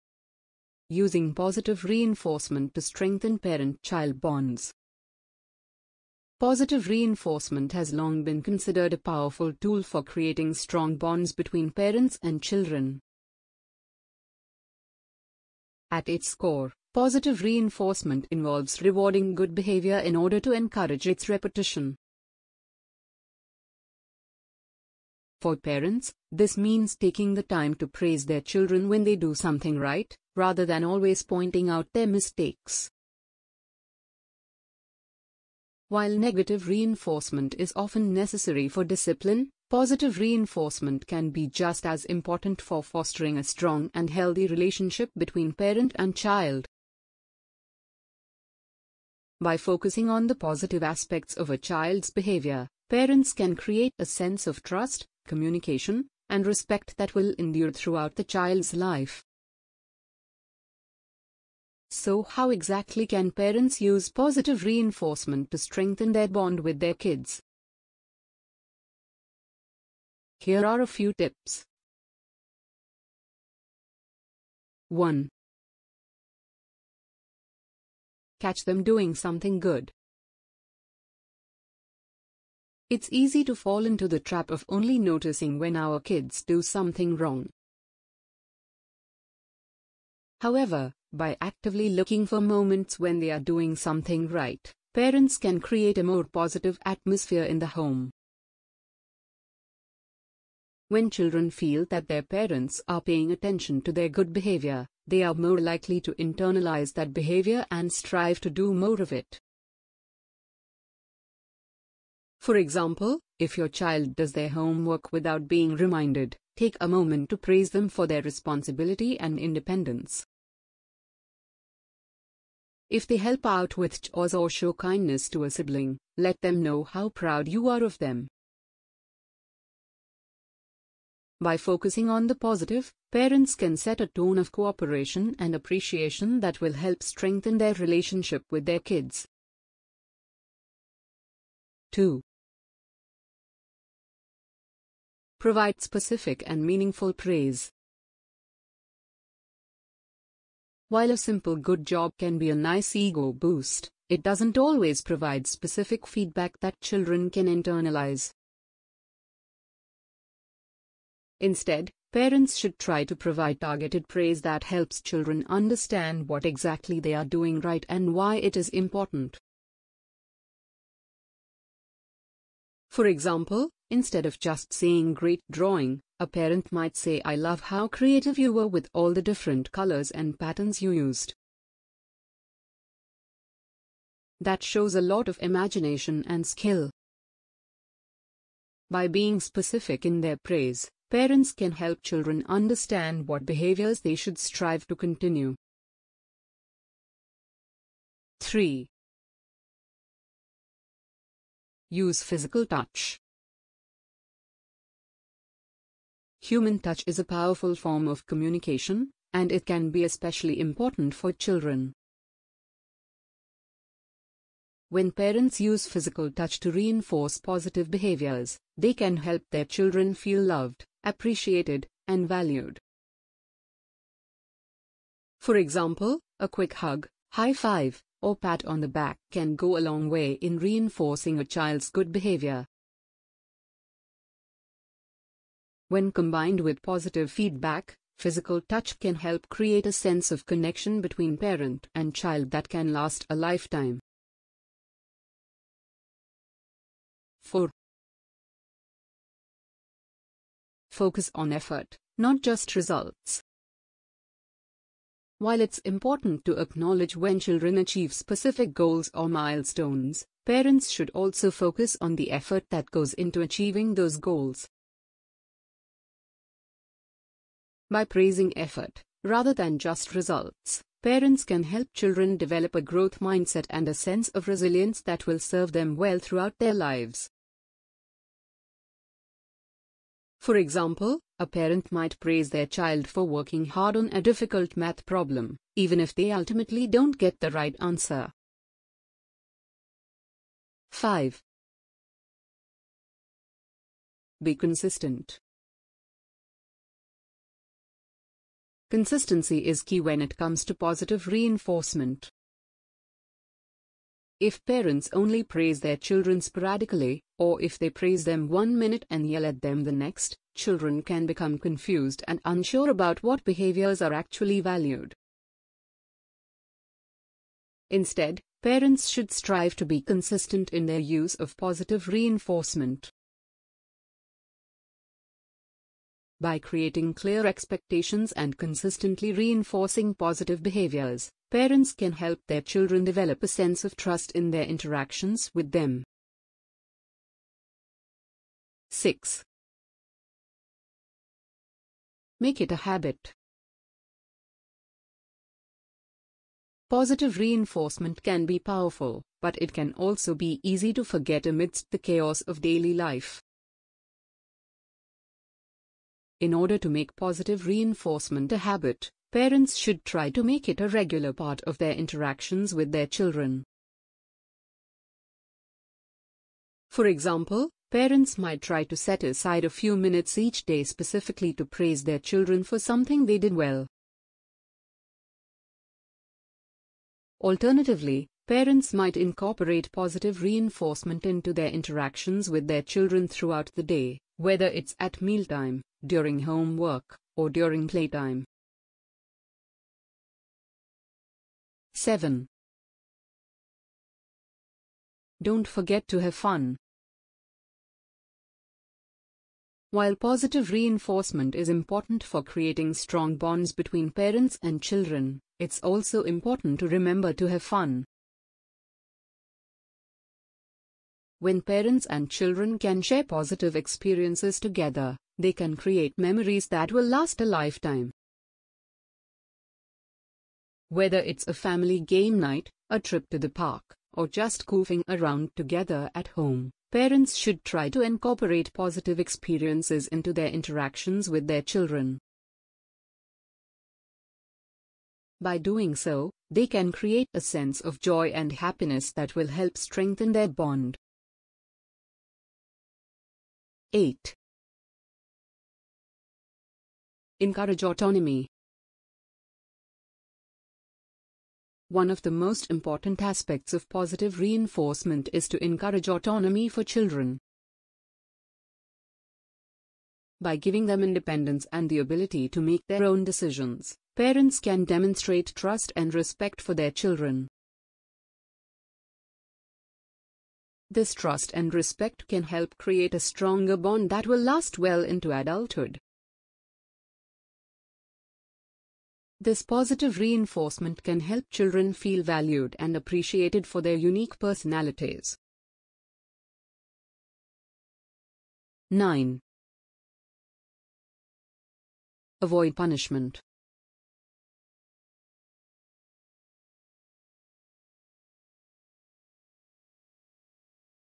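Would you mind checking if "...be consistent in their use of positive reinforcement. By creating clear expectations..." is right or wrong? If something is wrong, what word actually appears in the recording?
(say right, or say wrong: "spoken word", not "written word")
right.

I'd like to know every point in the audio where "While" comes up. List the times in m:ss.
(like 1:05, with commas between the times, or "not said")
0:35, 2:30, 4:15, 6:39.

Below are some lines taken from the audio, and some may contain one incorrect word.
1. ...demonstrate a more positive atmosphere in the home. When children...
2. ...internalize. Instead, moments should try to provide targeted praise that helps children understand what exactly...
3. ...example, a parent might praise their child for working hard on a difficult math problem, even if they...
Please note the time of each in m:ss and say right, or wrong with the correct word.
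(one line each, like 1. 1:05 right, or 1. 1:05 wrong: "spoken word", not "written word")
1. 1:35 wrong: "create", not "demonstrate"
2. 2:37 wrong: "parents", not "moments"
3. 4:40 right.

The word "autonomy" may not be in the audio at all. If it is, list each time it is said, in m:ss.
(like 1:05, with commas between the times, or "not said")
7:27, 7:36.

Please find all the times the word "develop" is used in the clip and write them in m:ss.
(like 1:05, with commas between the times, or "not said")
4:32, 5:33.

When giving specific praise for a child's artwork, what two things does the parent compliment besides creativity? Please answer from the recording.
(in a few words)
Colors and patterns.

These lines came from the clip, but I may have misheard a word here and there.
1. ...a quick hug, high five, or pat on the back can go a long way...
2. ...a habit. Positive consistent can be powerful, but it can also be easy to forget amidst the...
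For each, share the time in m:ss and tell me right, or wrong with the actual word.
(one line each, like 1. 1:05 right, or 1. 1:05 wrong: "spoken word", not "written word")
1. 3:46 right
2. 5:42 wrong: "reinforcement", not "consistent".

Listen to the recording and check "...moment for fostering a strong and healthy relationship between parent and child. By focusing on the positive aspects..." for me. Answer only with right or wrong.
wrong.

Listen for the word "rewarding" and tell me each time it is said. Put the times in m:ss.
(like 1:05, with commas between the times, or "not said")
0:18.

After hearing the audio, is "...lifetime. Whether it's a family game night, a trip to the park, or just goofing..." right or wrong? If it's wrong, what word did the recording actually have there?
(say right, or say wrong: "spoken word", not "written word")
right.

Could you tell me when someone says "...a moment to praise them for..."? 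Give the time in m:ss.
1:56.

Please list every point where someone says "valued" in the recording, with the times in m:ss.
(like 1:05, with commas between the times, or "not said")
3:42, 5:14, 8:02.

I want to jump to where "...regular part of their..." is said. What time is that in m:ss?
6:00.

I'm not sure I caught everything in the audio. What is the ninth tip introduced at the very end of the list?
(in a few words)
Avoid punishment.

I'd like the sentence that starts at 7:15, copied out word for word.
By doing so, they can create a sense of joy and happiness that will help strengthen their bond.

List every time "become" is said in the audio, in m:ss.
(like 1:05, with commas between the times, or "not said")
5:11.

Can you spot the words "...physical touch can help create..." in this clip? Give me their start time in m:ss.
3:58.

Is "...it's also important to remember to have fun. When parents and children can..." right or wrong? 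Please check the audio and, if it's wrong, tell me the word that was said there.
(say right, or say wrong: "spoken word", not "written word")
right.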